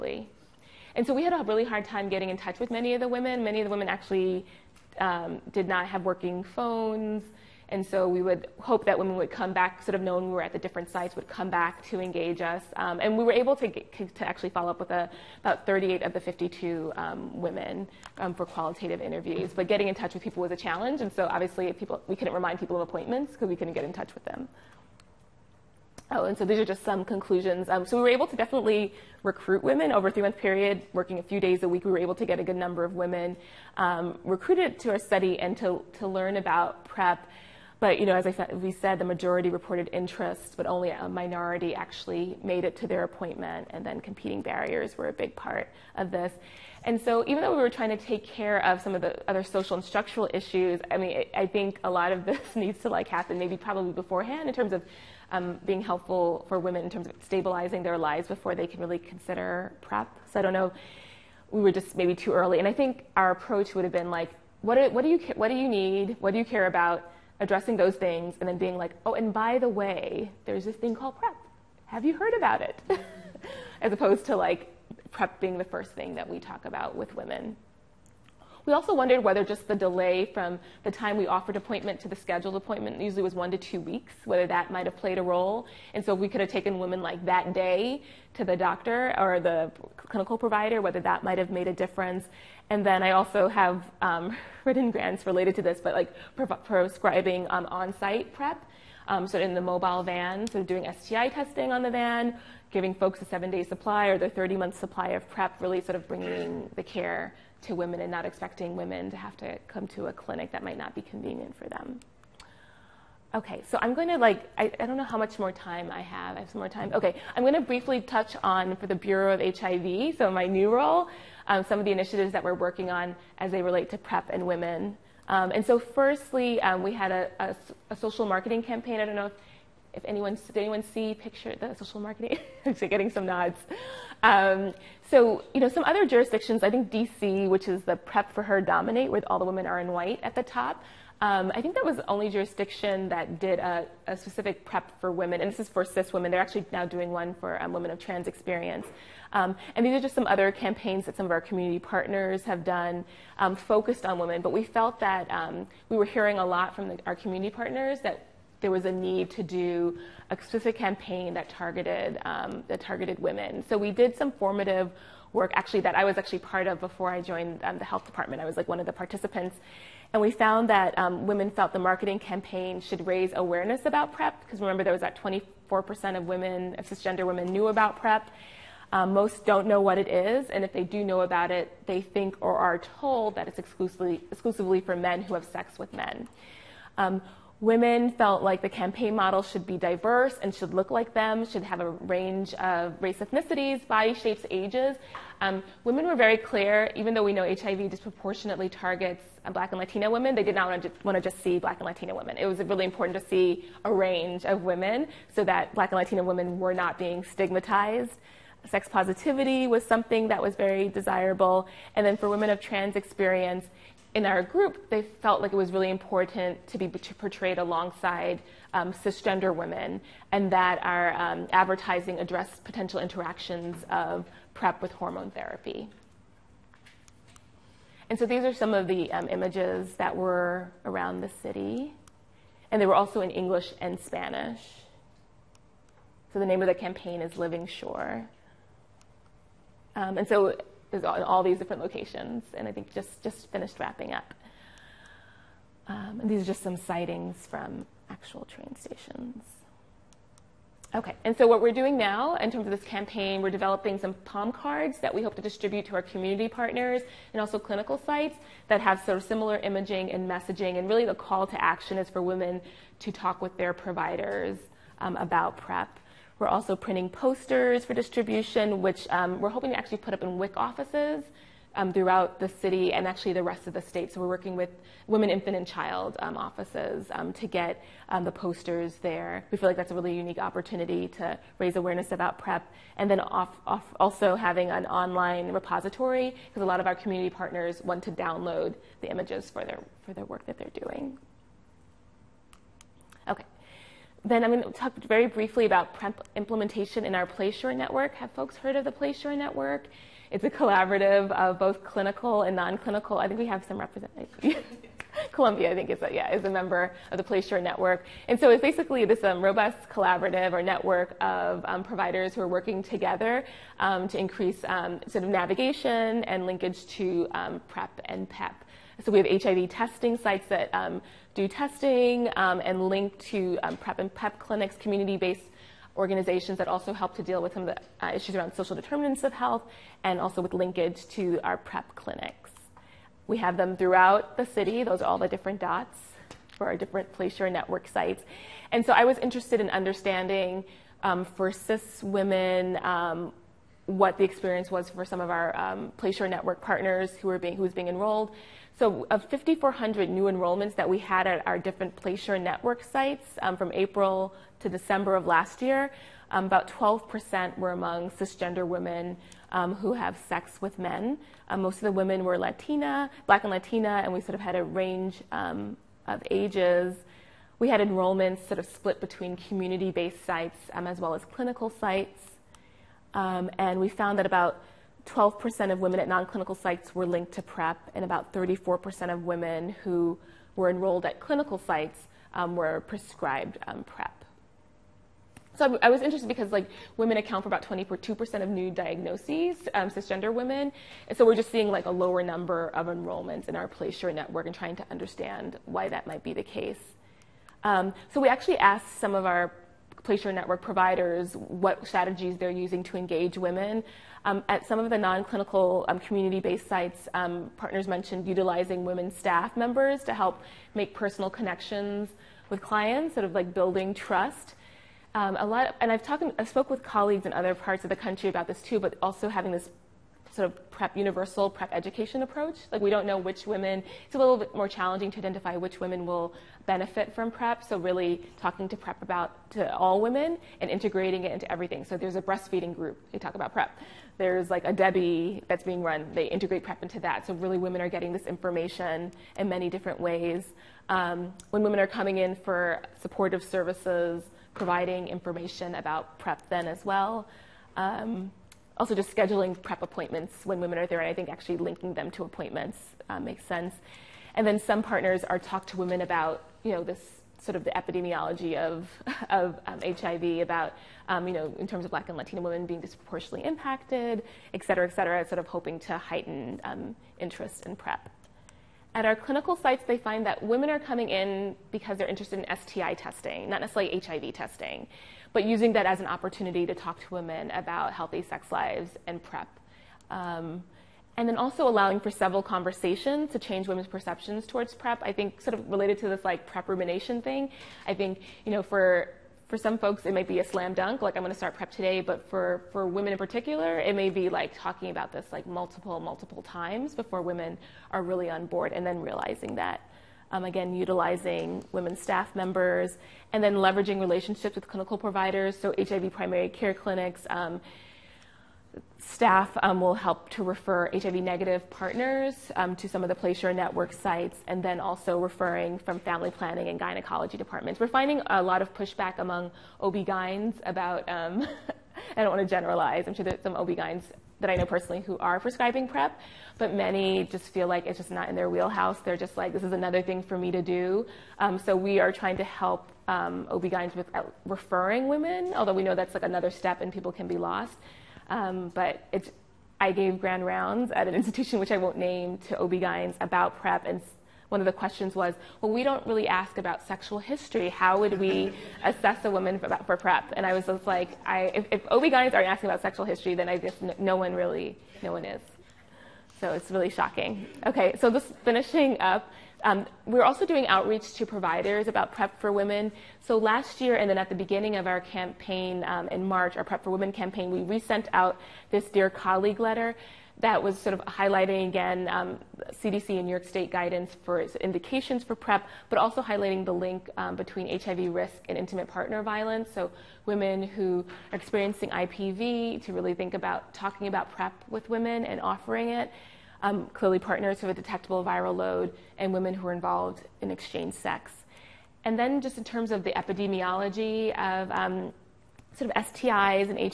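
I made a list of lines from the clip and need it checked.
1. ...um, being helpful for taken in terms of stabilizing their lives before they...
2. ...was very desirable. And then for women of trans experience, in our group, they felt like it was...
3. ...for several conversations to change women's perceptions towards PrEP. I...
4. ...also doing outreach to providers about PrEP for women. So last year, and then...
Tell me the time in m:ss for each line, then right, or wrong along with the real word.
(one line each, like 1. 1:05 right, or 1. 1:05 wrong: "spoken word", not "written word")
1. 0:55 wrong: "women", not "taken"
2. 3:30 right
3. 8:01 right
4. 9:20 right.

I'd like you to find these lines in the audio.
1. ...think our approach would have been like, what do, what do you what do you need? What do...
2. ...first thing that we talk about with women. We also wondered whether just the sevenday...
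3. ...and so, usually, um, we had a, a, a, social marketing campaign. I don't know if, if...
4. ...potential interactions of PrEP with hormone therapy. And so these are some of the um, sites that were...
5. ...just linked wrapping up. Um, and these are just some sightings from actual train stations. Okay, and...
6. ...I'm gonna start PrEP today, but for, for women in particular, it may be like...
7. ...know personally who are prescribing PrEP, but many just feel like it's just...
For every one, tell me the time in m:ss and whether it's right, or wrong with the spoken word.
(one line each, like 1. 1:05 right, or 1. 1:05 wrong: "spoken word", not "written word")
1. 1:02 right
2. 1:15 wrong: "delay", not "sevenday"
3. 2:05 wrong: "firstly", not "usually"
4. 3:42 wrong: "images", not "sites"
5. 4:03 wrong: "finished", not "linked"
6. 8:11 right
7. 8:44 right.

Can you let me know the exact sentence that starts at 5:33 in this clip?
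We have them throughout the city.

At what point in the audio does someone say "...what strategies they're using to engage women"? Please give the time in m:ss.
6:41.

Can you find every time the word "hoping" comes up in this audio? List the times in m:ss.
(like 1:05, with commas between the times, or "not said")
4:29, 7:45.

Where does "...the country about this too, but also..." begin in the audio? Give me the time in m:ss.
6:57.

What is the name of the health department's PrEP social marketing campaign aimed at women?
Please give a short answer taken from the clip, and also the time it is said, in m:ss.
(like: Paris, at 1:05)
Living Sure, at 3:57.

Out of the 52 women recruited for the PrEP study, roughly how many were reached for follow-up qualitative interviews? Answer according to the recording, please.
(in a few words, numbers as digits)
38.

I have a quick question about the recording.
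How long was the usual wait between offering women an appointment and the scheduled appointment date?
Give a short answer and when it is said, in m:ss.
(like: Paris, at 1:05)
1 to 2 weeks, at 1:23.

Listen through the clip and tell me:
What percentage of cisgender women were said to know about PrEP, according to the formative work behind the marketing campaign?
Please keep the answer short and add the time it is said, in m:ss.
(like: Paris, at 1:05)
24%, at 2:55.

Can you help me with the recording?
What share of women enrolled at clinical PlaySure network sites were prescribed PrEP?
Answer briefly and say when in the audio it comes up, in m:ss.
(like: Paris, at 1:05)
34%, at 6:18.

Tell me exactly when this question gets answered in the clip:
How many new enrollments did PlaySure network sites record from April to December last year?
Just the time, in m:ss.
5:49.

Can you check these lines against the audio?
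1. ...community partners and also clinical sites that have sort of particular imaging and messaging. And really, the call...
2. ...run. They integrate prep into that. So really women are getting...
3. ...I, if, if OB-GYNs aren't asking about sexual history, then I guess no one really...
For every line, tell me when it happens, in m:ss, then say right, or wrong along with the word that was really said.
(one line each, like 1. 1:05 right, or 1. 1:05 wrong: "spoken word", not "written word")
1. 4:16 wrong: "similar", not "particular"
2. 7:15 right
3. 9:11 right.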